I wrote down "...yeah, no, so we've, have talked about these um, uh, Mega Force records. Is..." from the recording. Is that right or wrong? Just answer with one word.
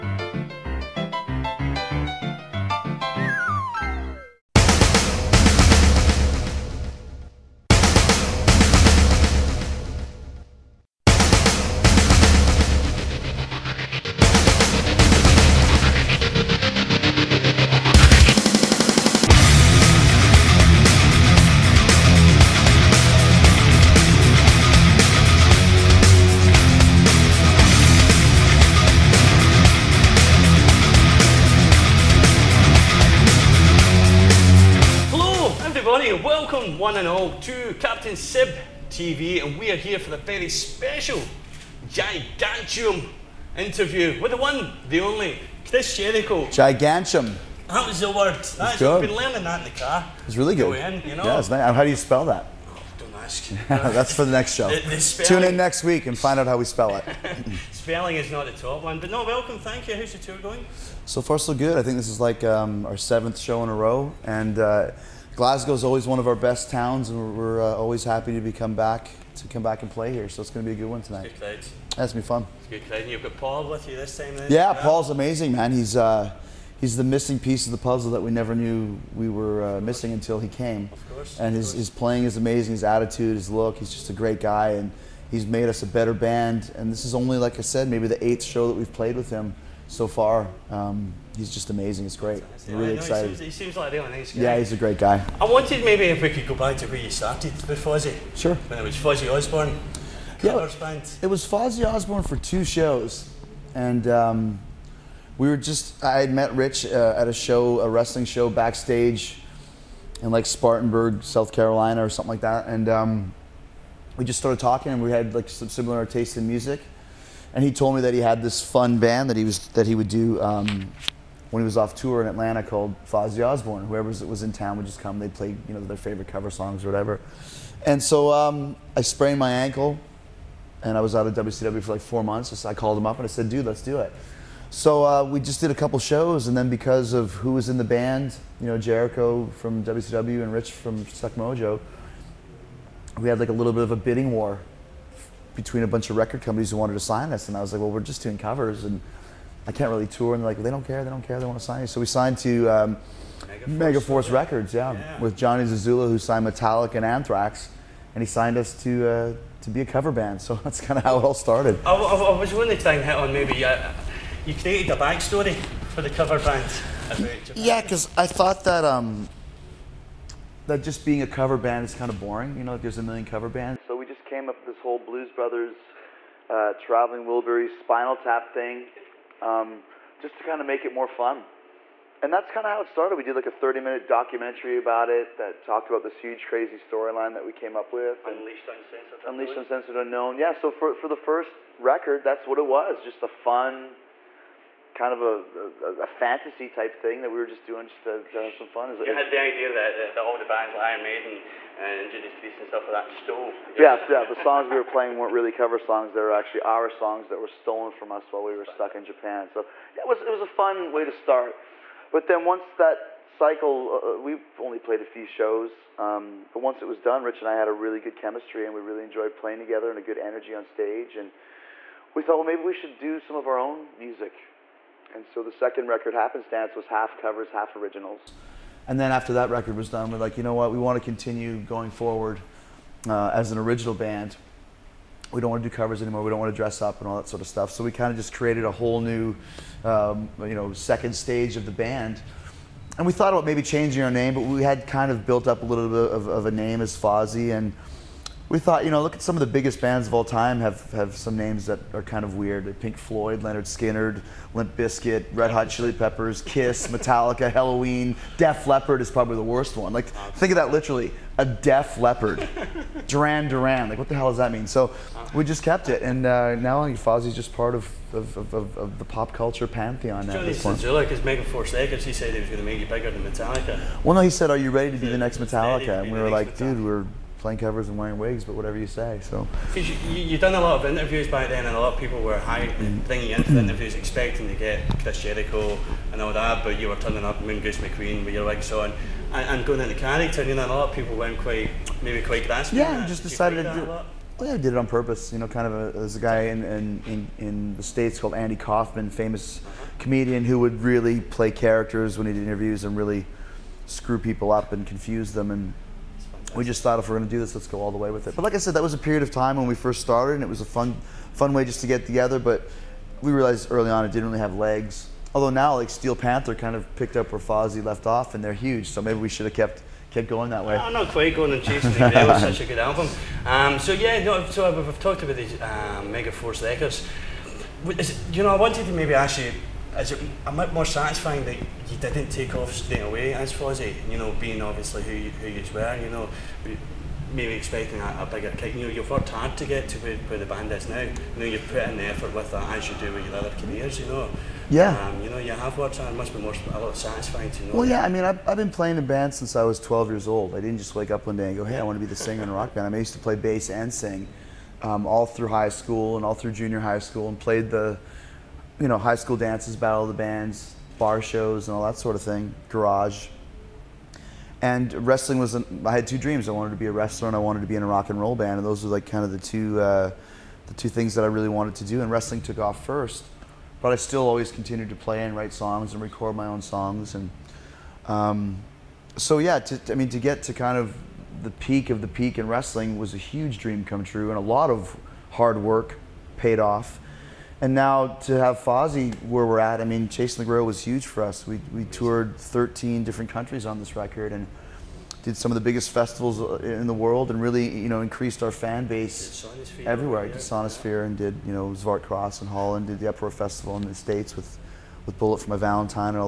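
right.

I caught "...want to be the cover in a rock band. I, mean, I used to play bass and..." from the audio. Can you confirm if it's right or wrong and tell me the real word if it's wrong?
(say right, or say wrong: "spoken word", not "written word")
wrong: "singer", not "cover".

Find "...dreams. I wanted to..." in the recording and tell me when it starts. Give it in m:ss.
6:06.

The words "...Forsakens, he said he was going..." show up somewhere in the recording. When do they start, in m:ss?
4:31.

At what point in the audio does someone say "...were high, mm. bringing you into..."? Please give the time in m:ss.
4:42.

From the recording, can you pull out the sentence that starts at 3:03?
We did like a 30 minute documentary about it that talked about this huge, crazy storyline that we came up with.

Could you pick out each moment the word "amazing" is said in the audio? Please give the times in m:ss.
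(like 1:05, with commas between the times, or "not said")
1:15, 1:22, 1:31.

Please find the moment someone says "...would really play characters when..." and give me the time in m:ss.
5:00.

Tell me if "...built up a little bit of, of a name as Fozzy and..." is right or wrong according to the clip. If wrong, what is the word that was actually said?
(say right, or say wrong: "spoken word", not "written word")
right.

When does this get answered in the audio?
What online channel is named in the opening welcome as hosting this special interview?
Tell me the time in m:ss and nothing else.
0:37.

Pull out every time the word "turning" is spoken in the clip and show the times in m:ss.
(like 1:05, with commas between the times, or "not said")
4:46.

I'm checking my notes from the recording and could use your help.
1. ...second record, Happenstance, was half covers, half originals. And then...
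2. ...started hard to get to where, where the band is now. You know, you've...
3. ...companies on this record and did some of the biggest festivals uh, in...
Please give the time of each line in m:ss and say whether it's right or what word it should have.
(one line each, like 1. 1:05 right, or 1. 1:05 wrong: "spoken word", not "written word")
1. 3:45 right
2. 5:39 wrong: "worked", not "started"
3. 6:33 wrong: "countries", not "companies".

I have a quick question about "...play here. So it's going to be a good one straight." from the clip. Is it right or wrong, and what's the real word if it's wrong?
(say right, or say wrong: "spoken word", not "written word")
wrong: "tonight", not "straight".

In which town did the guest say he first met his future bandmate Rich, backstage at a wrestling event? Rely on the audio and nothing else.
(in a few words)
Spartanburg, South Carolina.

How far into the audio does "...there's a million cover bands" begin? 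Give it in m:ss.
2:52.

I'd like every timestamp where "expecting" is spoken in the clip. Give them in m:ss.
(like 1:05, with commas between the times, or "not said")
4:43, 5:37.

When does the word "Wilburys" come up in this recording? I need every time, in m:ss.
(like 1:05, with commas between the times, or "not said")
2:57.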